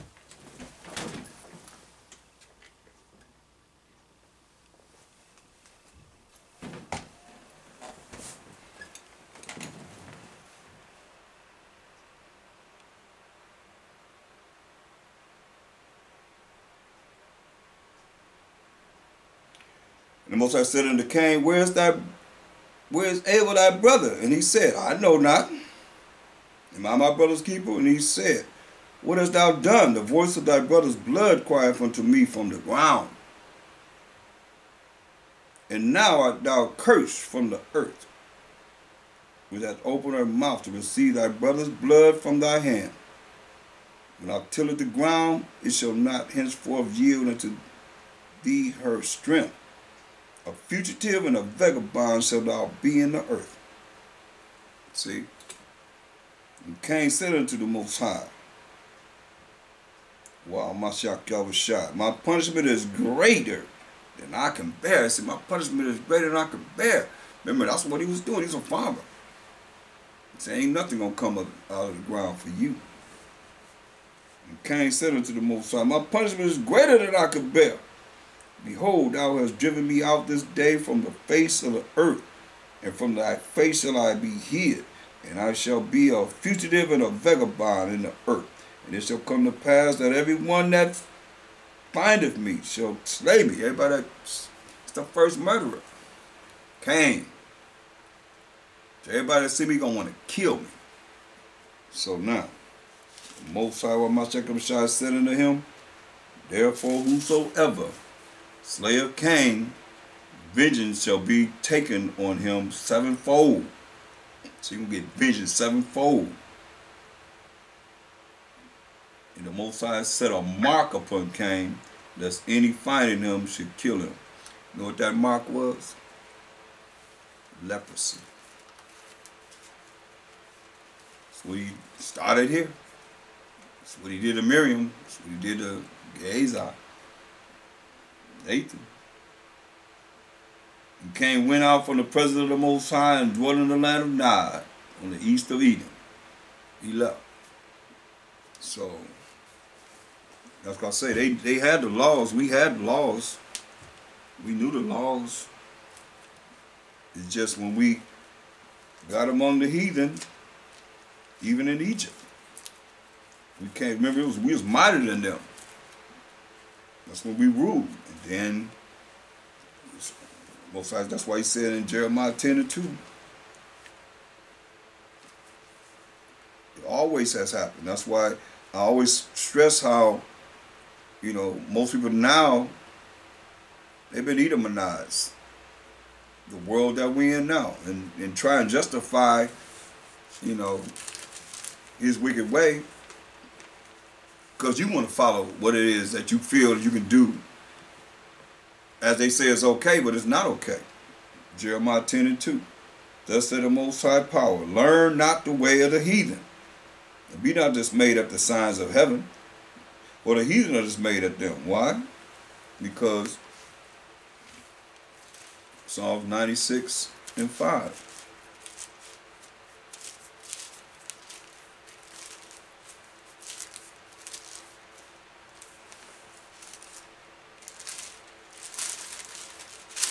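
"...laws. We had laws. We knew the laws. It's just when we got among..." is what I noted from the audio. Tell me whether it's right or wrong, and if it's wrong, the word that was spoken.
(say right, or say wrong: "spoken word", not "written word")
right.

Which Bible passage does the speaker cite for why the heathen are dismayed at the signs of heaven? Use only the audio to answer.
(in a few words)
Psalms 96:5.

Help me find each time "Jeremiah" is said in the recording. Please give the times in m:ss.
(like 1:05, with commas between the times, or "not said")
2:51, 3:21.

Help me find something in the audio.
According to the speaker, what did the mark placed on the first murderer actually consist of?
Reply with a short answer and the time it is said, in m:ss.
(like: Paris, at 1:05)
Leprosy, at 2:07.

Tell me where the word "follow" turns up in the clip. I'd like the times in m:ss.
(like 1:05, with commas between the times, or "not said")
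3:15.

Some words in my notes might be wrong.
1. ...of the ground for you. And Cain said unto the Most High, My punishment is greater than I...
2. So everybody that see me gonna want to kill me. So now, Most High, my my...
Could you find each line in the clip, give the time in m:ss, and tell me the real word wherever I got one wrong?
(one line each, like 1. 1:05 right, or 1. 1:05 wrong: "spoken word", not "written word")
1. 1:11 right
2. 1:39 right.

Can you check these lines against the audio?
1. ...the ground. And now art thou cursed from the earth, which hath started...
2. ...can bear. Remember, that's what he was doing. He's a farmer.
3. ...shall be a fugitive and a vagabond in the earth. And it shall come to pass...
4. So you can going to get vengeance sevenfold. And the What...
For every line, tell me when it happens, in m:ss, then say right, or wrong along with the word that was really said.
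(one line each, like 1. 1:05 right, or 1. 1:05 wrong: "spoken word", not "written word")
1. 0:32 wrong: "opened", not "started"
2. 1:06 right
3. 1:25 right
4. 1:54 wrong: "Most", not "What".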